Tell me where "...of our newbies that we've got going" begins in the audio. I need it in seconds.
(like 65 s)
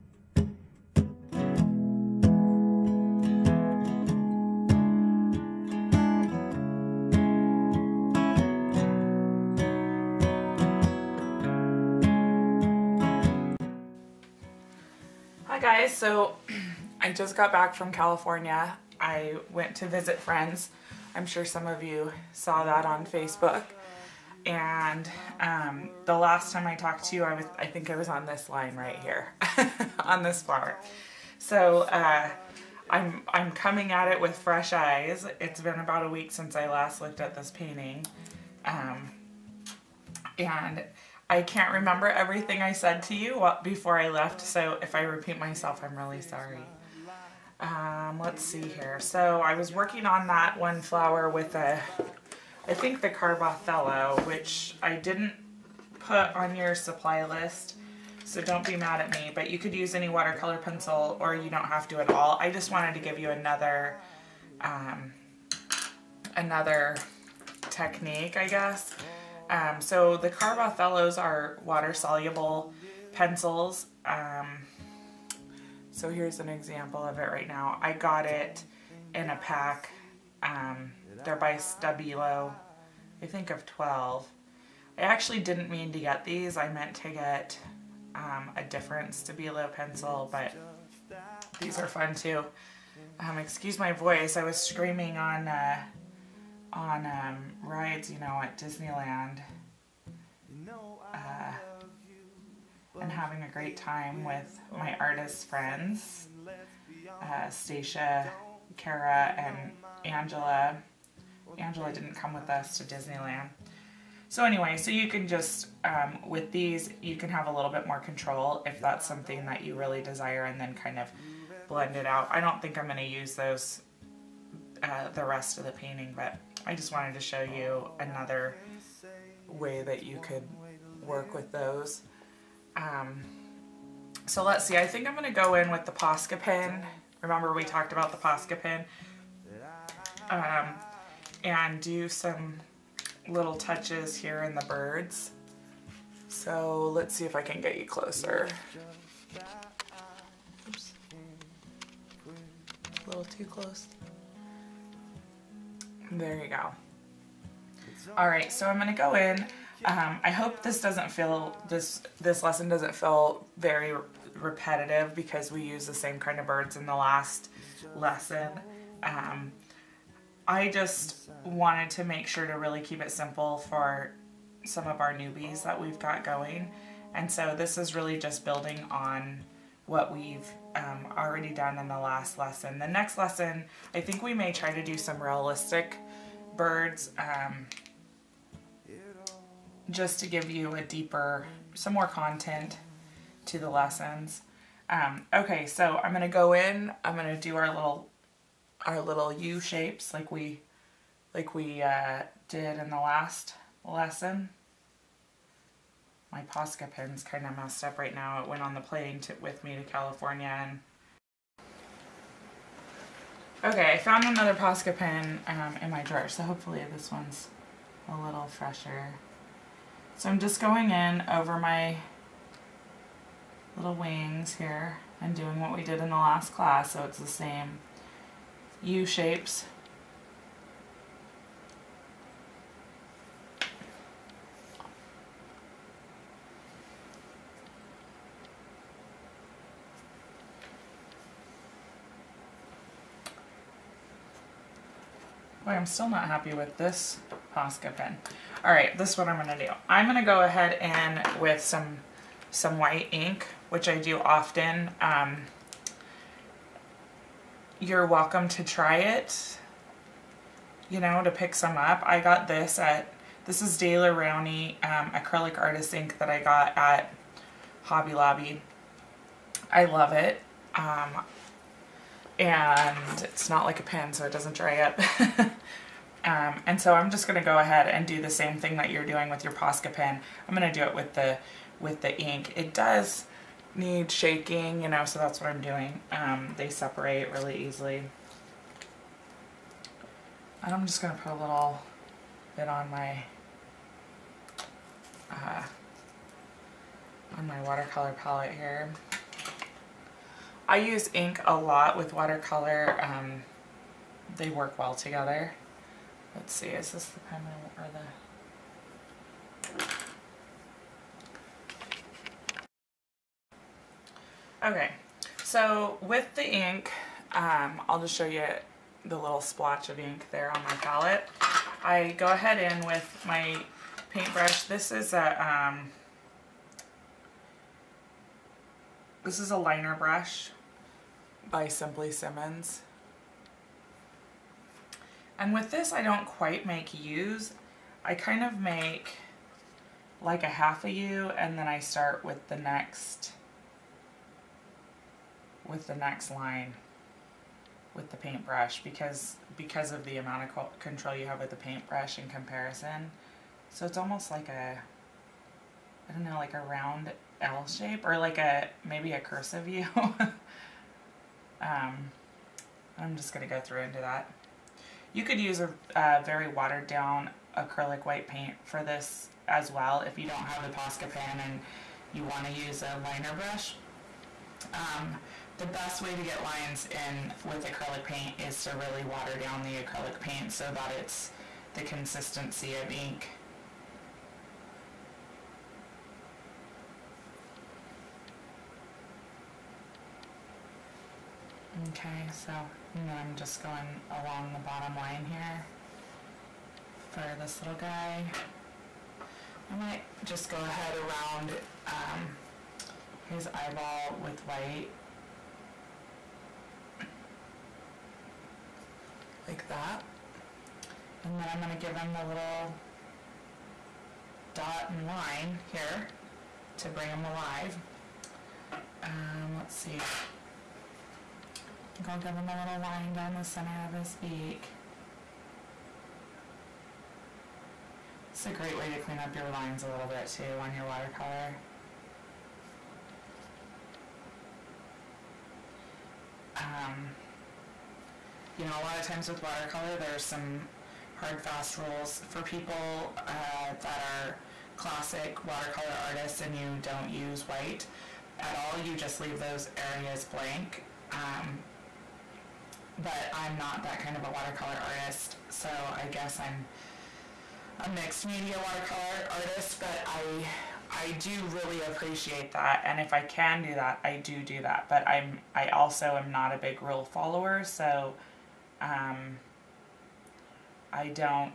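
174 s.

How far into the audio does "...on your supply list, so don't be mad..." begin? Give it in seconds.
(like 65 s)
56 s.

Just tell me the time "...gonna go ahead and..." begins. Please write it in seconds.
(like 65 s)
250 s.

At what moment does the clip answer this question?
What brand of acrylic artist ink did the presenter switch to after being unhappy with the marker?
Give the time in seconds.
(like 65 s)
263 s.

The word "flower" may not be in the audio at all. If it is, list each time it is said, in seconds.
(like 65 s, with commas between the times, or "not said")
30 s, 50 s.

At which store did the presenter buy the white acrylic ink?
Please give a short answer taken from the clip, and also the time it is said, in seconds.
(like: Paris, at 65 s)
Hobby Lobby, at 267 s.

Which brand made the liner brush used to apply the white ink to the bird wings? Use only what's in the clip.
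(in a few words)
Simply Simmons.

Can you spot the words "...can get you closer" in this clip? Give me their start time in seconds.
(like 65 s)
147 s.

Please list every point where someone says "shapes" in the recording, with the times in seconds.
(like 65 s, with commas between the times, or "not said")
199 s, 229 s, 357 s.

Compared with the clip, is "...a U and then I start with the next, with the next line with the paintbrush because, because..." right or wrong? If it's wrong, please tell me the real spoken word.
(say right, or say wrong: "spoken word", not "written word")
right.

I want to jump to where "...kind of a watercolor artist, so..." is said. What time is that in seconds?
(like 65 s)
453 s.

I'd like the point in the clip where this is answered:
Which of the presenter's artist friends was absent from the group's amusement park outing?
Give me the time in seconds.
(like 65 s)
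111 s.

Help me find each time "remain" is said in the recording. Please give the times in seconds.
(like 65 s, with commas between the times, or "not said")
not said.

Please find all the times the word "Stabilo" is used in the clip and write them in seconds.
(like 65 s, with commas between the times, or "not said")
81 s, 89 s.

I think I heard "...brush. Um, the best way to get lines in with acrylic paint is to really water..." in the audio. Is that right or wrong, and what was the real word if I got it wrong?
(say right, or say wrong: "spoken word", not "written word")
right.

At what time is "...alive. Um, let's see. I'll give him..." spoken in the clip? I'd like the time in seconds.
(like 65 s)
417 s.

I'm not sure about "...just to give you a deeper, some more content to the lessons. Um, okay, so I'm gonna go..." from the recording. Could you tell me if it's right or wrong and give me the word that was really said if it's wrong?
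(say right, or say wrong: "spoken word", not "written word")
right.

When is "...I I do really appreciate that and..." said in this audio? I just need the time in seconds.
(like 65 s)
460 s.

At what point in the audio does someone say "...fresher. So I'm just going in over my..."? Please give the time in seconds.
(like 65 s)
218 s.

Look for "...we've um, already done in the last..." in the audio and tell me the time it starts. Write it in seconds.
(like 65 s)
180 s.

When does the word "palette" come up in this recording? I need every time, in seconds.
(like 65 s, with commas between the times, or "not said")
298 s, 320 s.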